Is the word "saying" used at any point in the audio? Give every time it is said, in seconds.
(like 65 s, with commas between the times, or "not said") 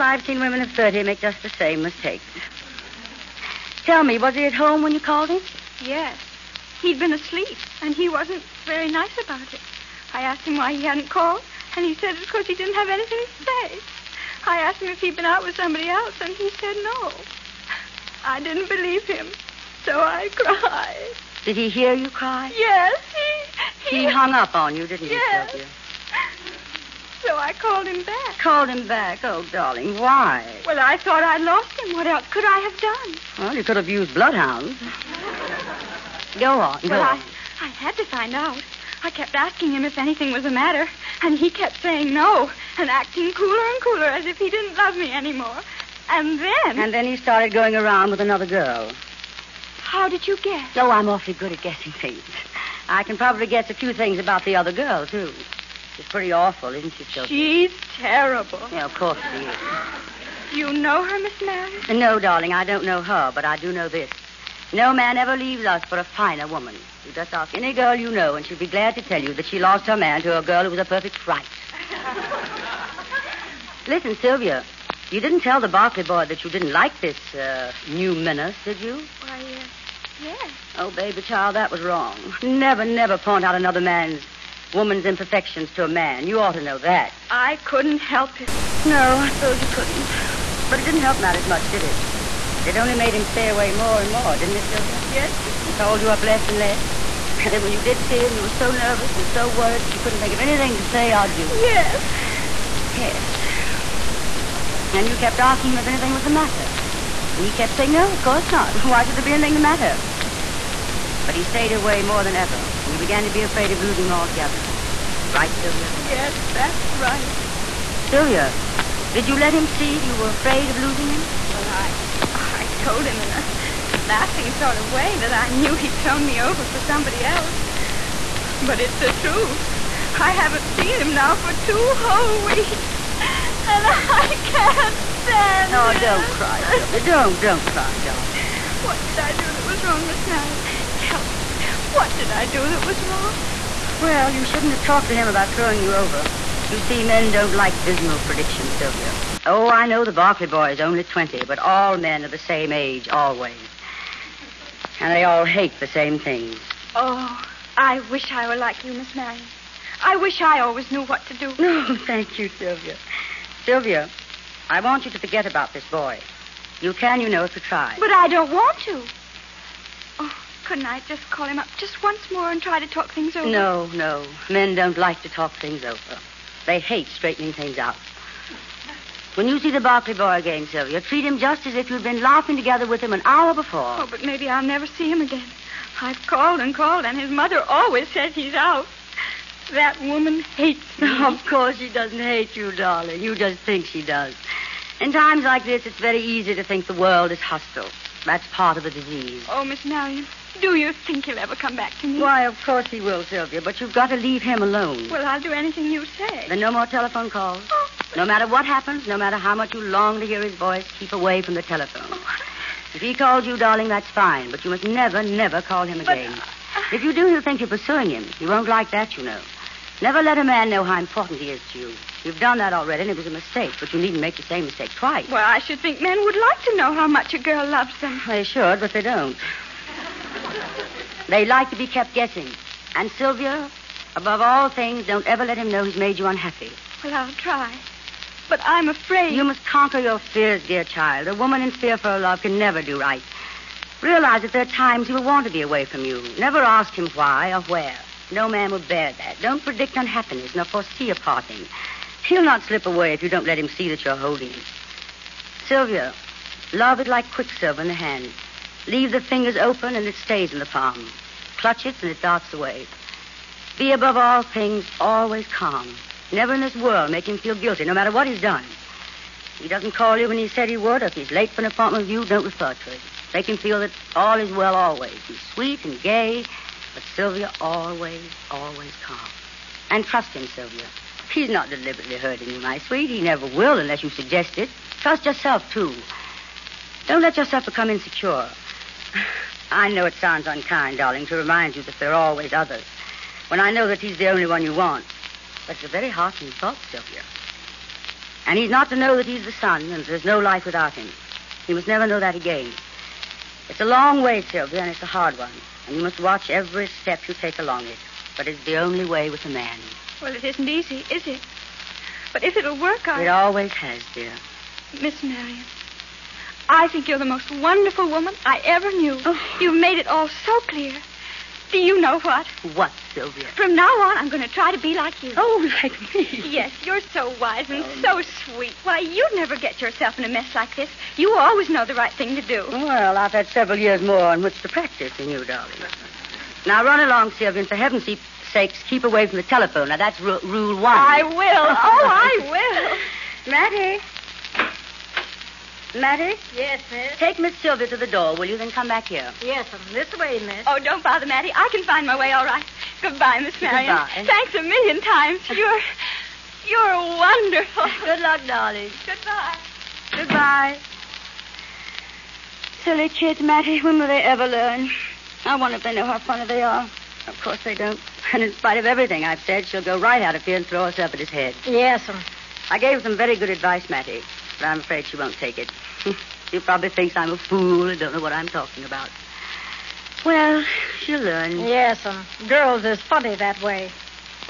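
41 s, 107 s.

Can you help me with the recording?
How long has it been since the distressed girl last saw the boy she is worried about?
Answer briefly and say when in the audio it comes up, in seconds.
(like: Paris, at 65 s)
two whole weeks, at 131 s.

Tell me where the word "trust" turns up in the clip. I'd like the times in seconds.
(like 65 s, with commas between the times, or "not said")
280 s, 285 s.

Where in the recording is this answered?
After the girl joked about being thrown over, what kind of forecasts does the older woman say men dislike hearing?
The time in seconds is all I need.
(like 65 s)
147 s.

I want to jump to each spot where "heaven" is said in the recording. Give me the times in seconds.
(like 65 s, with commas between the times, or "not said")
337 s.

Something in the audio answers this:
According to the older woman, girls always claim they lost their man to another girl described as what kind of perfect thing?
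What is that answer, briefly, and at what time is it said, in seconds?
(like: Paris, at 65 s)
a perfect fright, at 70 s.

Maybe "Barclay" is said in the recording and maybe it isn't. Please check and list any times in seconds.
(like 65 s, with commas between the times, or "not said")
75 s, 150 s, 179 s.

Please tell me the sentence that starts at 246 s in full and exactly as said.
Never ask him why or where.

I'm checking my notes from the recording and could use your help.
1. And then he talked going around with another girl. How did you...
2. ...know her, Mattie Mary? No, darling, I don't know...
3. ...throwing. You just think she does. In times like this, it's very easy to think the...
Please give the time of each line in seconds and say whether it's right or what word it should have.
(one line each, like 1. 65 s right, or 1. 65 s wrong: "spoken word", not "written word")
1. 46 s wrong: "started", not "talked"
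2. 60 s wrong: "Miss", not "Mattie"
3. 192 s wrong: "darling", not "throwing".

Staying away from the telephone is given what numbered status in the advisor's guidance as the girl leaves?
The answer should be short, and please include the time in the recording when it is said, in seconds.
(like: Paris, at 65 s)
rule one, at 340 s.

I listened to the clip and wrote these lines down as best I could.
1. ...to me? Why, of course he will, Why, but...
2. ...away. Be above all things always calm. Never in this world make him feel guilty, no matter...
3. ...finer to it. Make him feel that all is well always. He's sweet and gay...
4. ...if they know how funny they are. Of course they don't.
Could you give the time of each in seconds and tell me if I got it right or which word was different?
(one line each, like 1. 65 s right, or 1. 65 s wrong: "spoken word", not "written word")
1. 202 s wrong: "Sylvia", not "Why"
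2. 262 s right
3. 272 s wrong: "refer", not "finer"
4. 365 s right.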